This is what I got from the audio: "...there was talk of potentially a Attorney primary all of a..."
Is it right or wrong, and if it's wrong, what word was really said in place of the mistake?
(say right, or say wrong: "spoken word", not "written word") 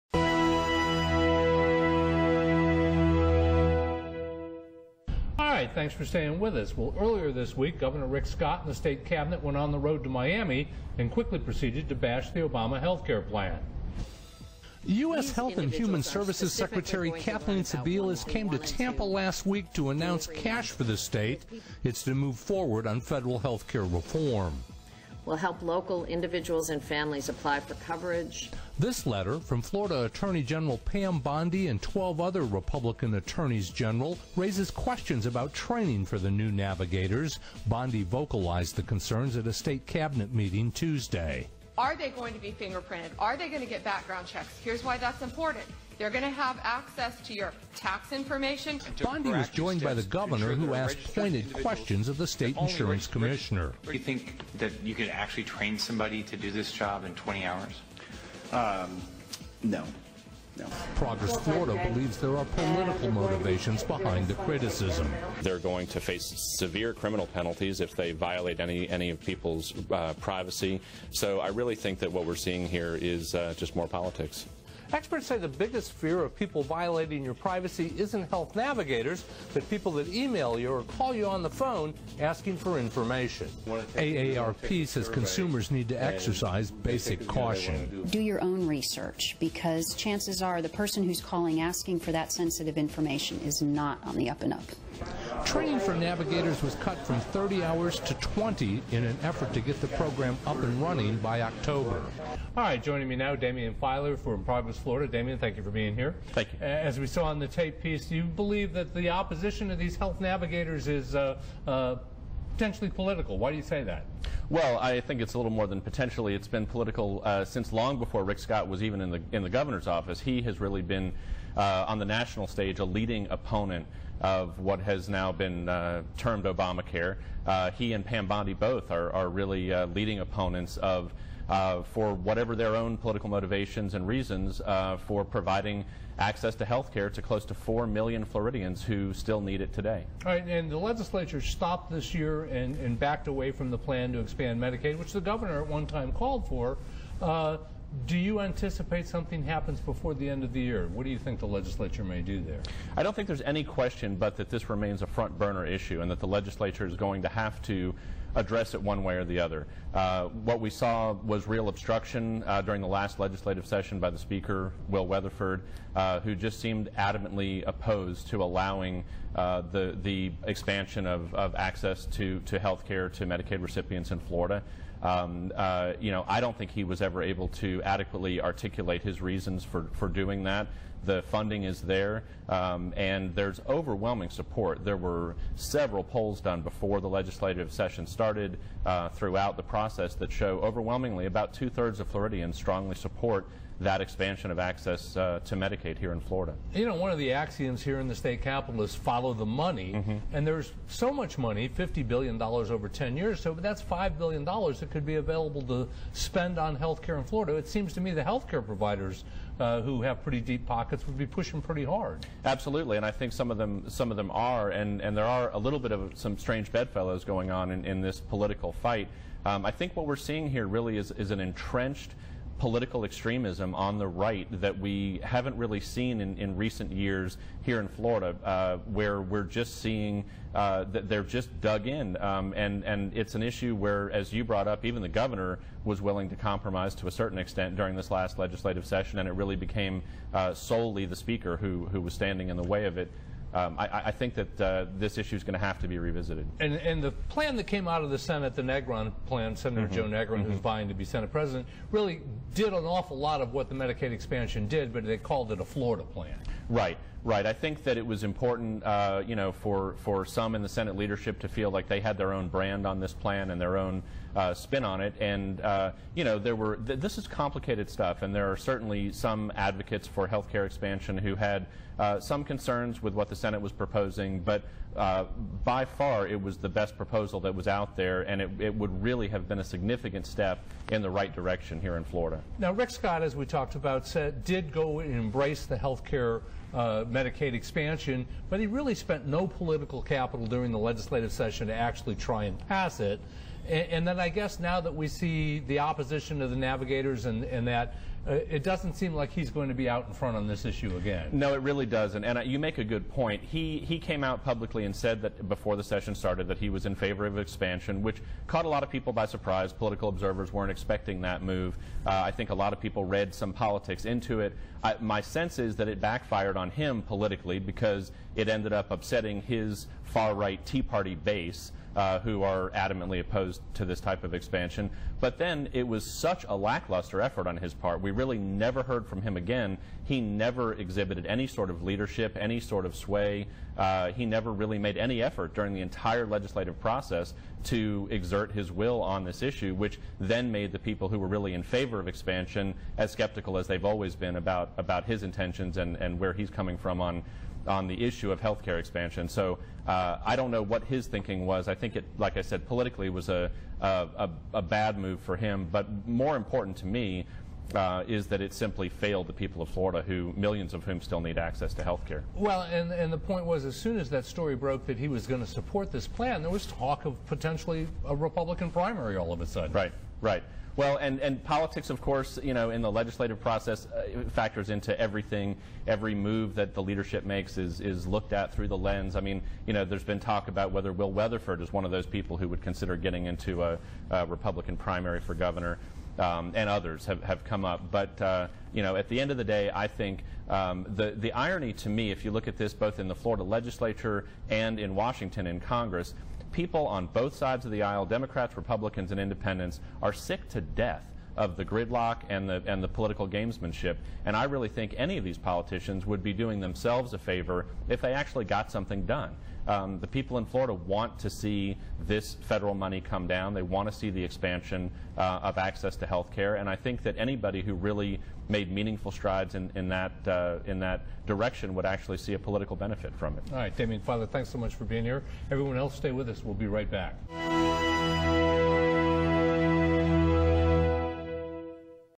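wrong: "Republican", not "Attorney".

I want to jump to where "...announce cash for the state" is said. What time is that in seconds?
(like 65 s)
19 s.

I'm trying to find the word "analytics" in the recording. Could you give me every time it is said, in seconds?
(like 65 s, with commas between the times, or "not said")
not said.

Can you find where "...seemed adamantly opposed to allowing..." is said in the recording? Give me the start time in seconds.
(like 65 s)
166 s.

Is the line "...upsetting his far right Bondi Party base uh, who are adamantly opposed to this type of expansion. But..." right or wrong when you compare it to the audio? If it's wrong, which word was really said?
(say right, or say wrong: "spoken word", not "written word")
wrong: "Tea", not "Bondi".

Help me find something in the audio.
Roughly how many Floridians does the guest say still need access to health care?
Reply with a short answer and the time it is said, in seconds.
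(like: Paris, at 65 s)
4 million, at 137 s.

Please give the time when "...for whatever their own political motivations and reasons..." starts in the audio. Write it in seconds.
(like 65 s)
131 s.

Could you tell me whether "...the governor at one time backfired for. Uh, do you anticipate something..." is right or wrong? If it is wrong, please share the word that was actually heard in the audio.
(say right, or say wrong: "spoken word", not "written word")
wrong: "called", not "backfired".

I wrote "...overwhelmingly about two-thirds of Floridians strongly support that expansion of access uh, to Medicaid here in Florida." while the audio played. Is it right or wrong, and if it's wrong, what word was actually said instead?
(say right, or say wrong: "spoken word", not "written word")
right.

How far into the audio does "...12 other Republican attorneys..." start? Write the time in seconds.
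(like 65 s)
31 s.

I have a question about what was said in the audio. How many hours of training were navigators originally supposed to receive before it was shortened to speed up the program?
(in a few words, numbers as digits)
30.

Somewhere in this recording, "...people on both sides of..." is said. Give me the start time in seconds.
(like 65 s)
396 s.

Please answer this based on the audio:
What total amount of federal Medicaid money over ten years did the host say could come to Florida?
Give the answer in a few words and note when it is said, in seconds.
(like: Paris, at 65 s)
$50 billion, at 201 s.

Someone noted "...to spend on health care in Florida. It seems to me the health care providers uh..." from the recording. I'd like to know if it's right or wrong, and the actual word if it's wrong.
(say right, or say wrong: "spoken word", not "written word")
right.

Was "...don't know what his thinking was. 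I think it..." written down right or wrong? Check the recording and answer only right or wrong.
right.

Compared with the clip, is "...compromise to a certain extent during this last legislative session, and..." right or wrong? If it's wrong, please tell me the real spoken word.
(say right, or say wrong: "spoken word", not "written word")
right.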